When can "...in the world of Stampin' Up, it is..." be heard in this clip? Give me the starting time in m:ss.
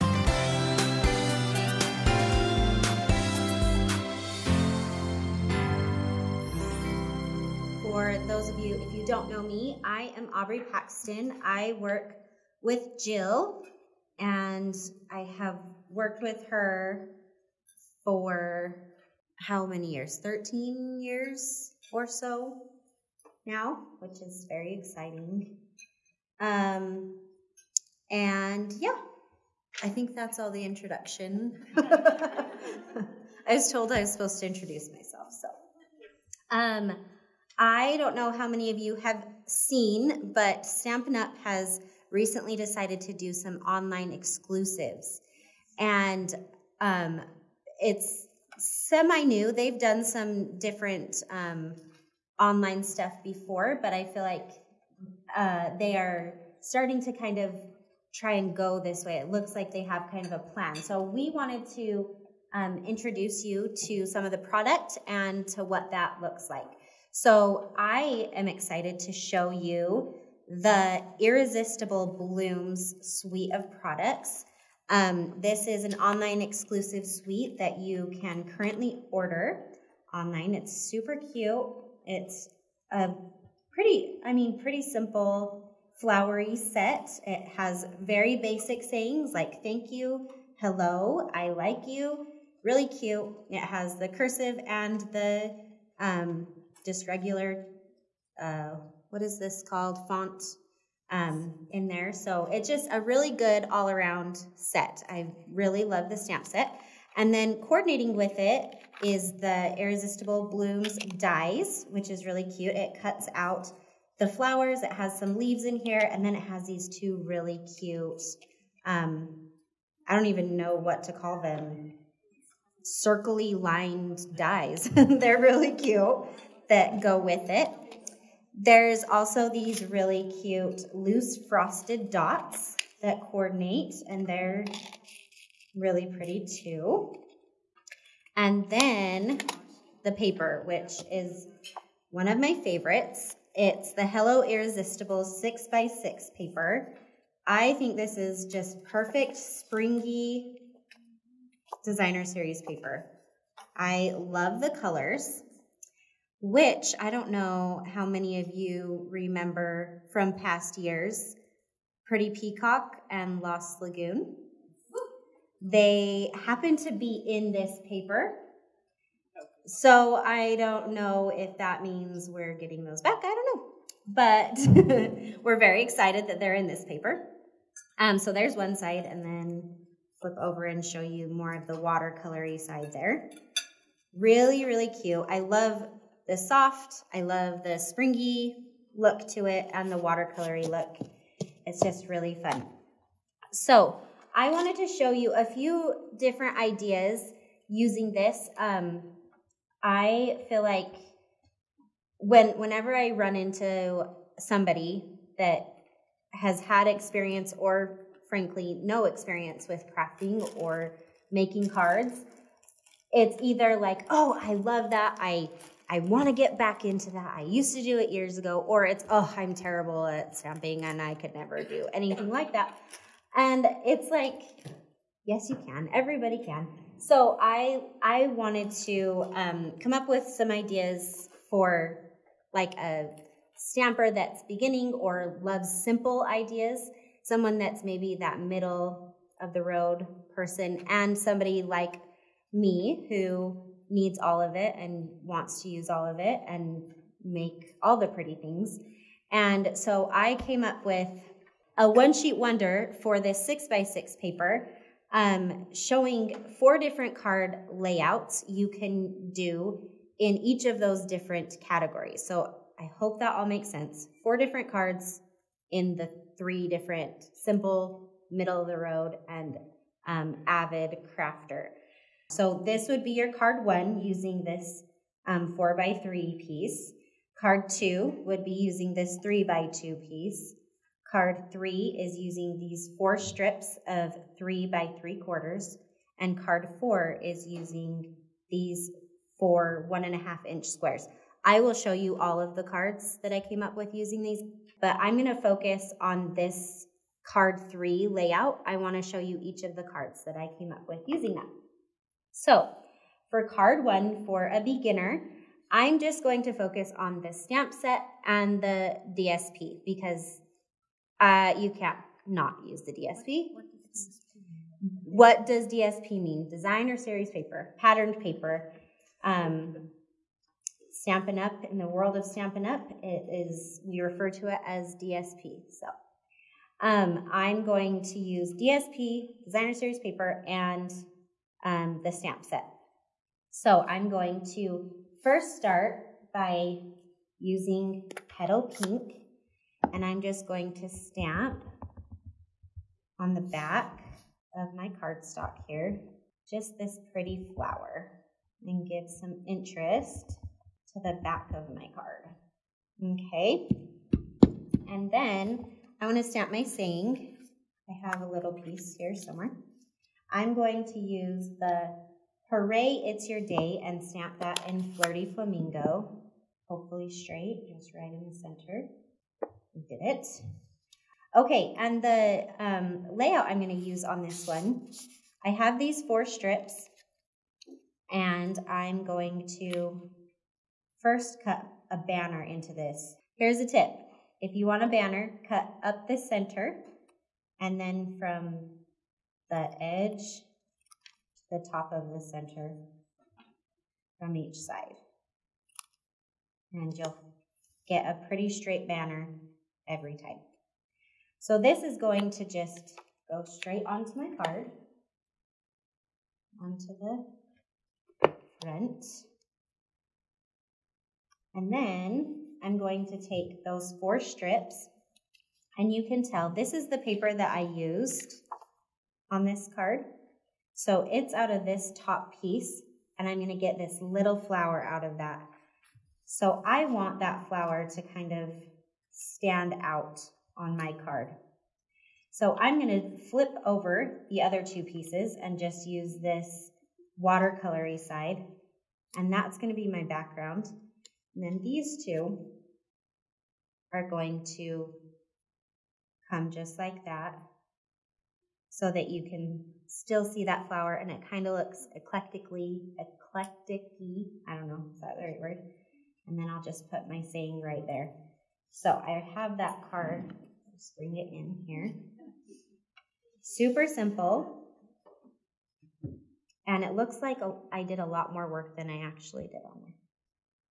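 5:21.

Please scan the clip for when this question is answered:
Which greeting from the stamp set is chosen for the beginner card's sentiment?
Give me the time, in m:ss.
6:02.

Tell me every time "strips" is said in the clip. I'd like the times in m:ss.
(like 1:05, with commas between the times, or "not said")
4:43, 6:16, 6:54.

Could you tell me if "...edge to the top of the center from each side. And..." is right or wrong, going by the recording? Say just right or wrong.
right.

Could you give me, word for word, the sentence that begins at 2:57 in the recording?
Um, so there's one side, and then flip over and show you more of the watercolory side there.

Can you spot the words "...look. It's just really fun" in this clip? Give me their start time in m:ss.
3:10.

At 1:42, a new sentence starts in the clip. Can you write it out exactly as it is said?
So it's just a really good all around set.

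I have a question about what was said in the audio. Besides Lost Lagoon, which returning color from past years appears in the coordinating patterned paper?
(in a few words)
Pretty Peacock.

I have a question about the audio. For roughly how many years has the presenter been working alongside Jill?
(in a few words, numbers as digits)
13 years.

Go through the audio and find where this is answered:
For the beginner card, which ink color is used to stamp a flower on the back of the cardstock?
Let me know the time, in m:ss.
5:38.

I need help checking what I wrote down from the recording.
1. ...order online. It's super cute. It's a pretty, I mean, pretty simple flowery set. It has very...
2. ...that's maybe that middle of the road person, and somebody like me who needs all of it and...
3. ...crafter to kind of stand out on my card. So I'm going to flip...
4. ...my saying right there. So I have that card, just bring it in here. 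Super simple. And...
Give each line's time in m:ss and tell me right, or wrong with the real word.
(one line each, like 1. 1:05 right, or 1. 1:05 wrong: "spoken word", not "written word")
1. 1:19 right
2. 3:57 right
3. 7:07 wrong: "flower", not "crafter"
4. 7:37 right.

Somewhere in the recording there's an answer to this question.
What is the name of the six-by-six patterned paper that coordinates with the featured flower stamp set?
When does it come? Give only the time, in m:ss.
2:24.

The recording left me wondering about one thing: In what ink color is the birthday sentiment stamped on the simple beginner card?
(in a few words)
Flirty Flamingo.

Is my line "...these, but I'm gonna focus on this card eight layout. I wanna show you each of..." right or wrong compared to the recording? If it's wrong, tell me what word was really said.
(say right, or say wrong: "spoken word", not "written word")
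wrong: "three", not "eight".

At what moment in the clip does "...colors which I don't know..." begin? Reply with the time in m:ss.
2:34.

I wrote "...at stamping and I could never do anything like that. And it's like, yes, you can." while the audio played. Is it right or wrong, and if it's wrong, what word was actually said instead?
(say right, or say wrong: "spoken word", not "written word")
right.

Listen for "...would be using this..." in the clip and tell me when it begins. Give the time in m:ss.
4:38.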